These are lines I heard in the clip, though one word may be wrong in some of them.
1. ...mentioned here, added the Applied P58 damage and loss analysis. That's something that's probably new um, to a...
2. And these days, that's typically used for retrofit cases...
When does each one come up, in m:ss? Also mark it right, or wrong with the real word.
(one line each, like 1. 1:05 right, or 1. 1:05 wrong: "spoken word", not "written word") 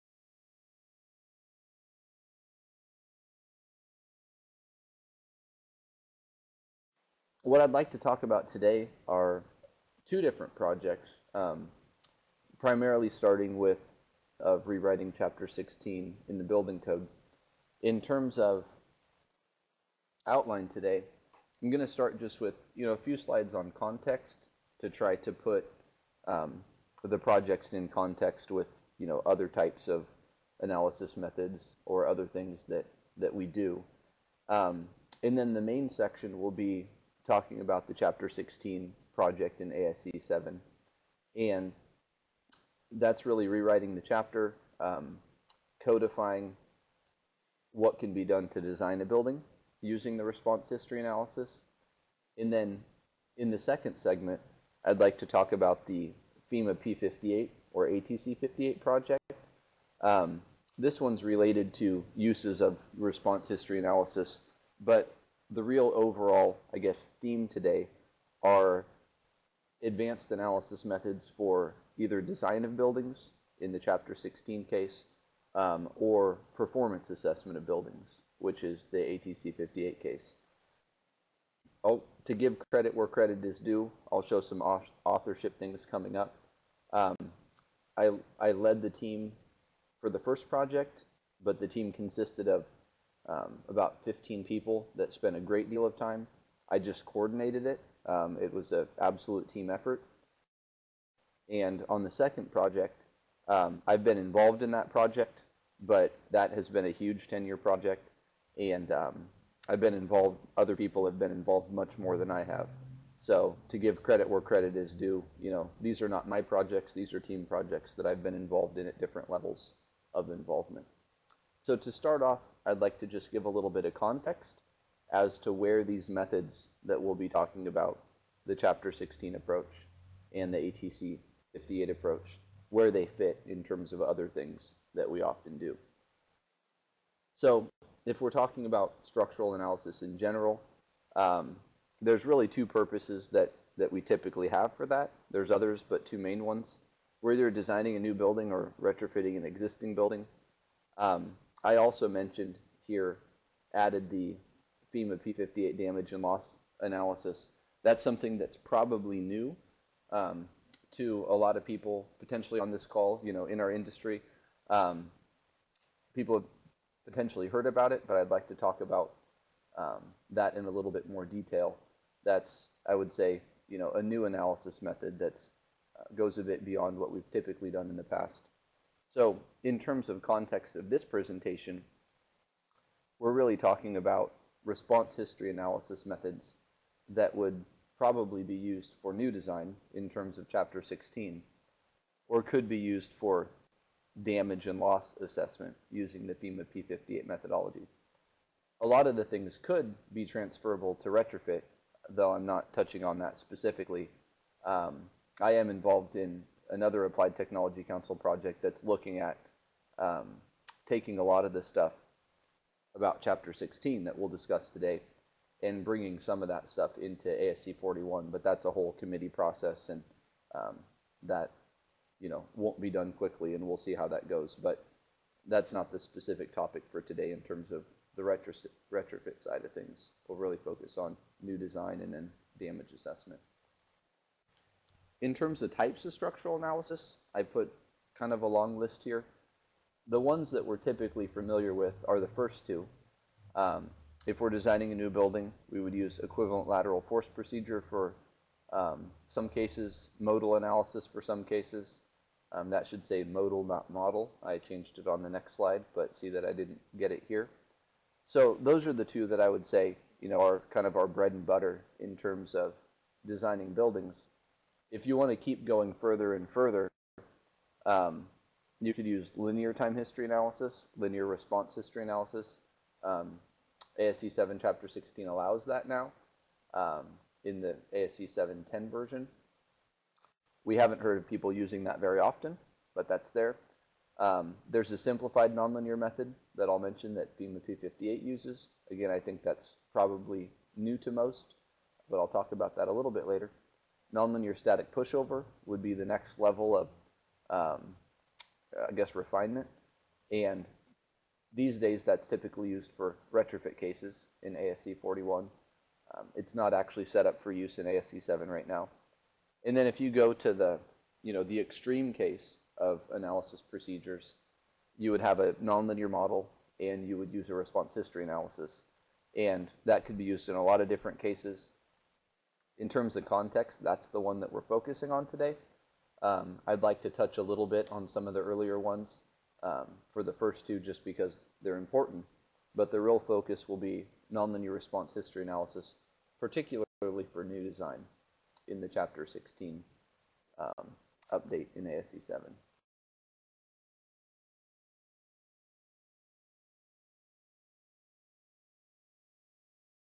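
1. 2:32 wrong: "FEMA", not "Applied"
2. 5:00 right.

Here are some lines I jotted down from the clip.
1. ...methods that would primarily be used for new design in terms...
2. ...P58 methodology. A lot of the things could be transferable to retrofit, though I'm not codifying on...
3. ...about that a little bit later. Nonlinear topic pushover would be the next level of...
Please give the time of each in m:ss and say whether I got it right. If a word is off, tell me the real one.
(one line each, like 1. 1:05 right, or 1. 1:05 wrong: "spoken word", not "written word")
1. 3:06 wrong: "probably", not "primarily"
2. 3:16 wrong: "touching", not "codifying"
3. 4:52 wrong: "static", not "topic".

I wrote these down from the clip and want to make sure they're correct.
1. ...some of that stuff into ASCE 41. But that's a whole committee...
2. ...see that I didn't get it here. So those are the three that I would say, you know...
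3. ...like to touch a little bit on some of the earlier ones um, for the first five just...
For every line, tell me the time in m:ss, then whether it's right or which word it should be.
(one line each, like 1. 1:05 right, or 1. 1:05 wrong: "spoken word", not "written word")
1. 3:36 right
2. 4:16 wrong: "two", not "three"
3. 5:26 wrong: "two", not "five".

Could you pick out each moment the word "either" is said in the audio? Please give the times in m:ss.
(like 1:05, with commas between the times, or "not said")
1:11, 2:27.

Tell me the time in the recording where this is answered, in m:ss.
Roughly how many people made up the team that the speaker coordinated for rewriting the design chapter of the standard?
1:33.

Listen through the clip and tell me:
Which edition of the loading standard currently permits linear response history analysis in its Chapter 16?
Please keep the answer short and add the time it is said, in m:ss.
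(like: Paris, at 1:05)
ASCE 7-10, at 4:37.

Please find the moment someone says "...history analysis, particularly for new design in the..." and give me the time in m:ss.
5:35.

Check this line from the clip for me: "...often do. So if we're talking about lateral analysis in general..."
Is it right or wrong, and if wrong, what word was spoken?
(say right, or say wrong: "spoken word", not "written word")
wrong: "structural", not "lateral".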